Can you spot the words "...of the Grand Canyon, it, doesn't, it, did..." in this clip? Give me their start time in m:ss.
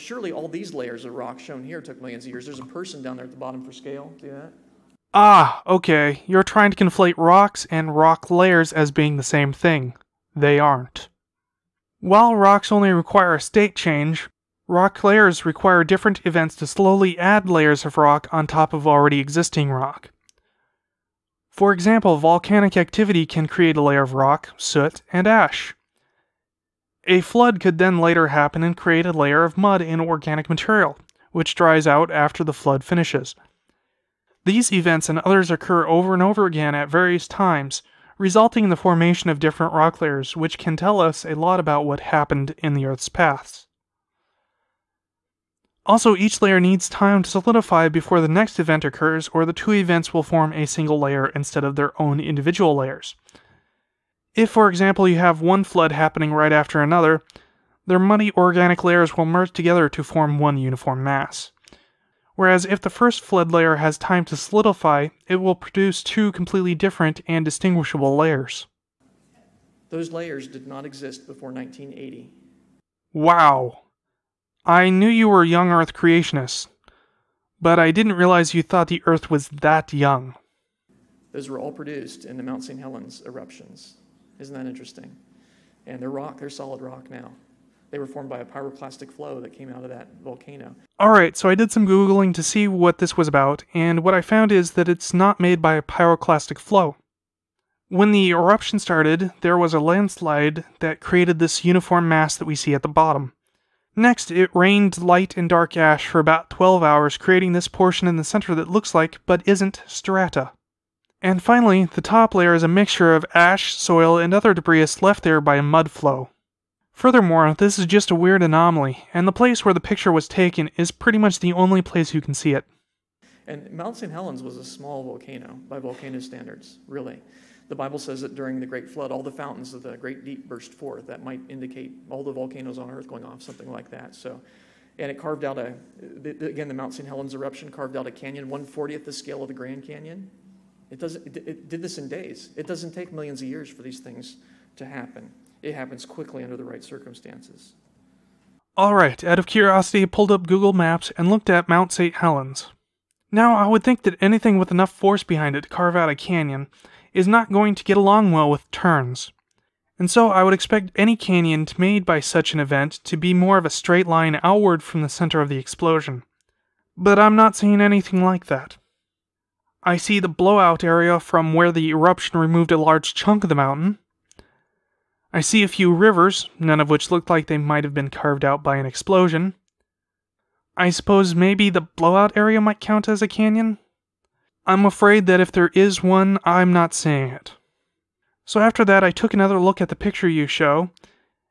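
2:19.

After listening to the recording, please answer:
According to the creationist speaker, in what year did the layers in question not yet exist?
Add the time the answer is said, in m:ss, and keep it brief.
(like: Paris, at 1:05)
1980, at 1:11.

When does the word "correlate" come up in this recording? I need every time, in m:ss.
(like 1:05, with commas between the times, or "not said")
not said.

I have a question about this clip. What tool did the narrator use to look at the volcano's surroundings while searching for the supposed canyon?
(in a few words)
Google Maps.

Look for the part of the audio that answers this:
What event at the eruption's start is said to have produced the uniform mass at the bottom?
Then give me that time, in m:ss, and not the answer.
1:39.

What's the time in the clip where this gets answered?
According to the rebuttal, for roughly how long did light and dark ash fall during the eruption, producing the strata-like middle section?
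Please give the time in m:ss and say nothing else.
1:46.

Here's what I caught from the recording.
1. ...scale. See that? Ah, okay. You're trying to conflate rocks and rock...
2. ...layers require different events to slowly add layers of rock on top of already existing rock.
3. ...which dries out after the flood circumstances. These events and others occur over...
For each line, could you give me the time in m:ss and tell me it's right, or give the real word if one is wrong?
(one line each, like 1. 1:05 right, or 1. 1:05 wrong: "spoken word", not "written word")
1. 0:03 right
2. 0:15 right
3. 0:31 wrong: "finishes", not "circumstances".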